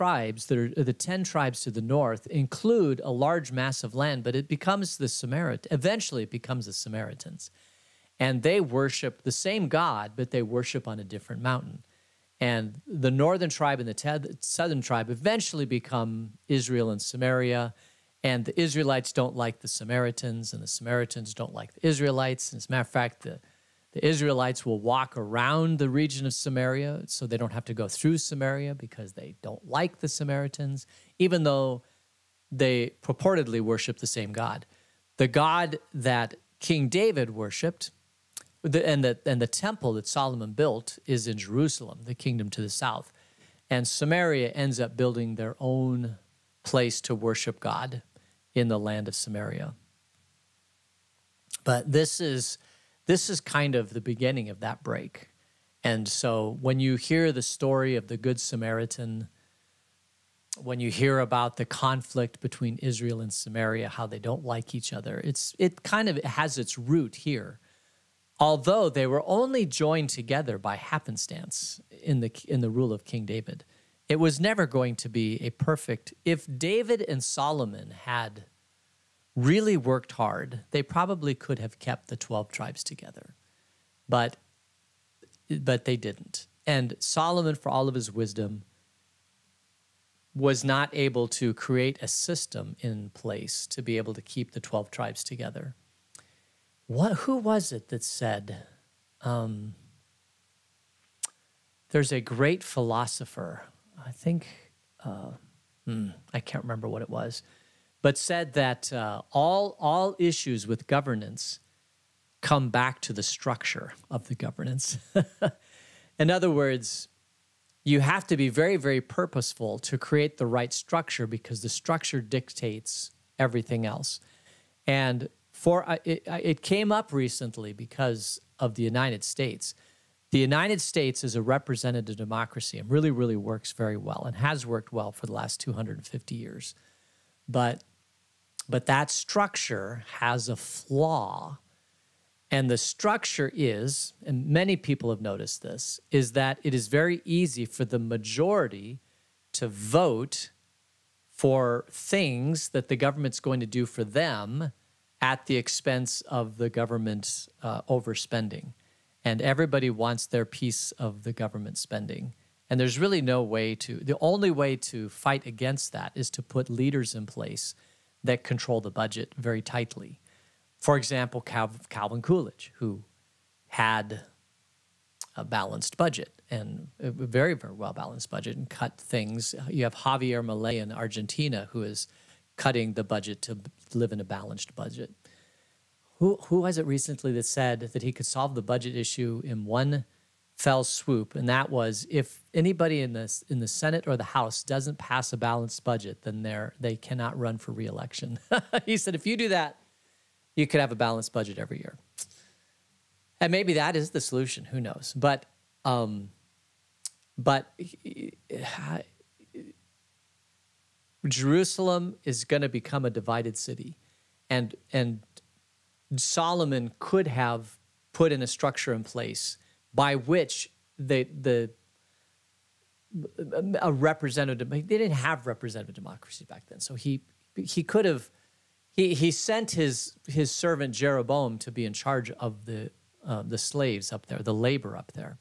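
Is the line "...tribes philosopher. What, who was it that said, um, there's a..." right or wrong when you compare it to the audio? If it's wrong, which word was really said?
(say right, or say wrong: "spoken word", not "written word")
wrong: "together", not "philosopher".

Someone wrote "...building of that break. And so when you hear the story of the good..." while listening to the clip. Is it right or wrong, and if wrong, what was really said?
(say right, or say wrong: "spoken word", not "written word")
wrong: "beginning", not "building".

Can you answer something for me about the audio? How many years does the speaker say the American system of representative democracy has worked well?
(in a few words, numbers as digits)
250 years.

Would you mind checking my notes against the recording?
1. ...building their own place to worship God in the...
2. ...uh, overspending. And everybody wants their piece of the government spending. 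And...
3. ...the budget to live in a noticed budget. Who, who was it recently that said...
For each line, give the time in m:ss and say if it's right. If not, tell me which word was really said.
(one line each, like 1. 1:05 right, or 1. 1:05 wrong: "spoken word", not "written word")
1. 0:44 right
2. 2:37 right
3. 3:02 wrong: "balanced", not "noticed".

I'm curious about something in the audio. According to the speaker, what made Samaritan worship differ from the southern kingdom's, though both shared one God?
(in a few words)
A different mountain.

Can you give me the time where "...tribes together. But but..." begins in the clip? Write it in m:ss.
1:22.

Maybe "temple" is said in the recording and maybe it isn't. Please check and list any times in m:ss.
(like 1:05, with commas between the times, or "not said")
0:39.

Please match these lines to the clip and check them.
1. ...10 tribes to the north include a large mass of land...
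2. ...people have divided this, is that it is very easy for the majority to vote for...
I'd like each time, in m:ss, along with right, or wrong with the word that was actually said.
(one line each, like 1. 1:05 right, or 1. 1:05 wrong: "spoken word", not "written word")
1. 0:00 right
2. 2:24 wrong: "noticed", not "divided".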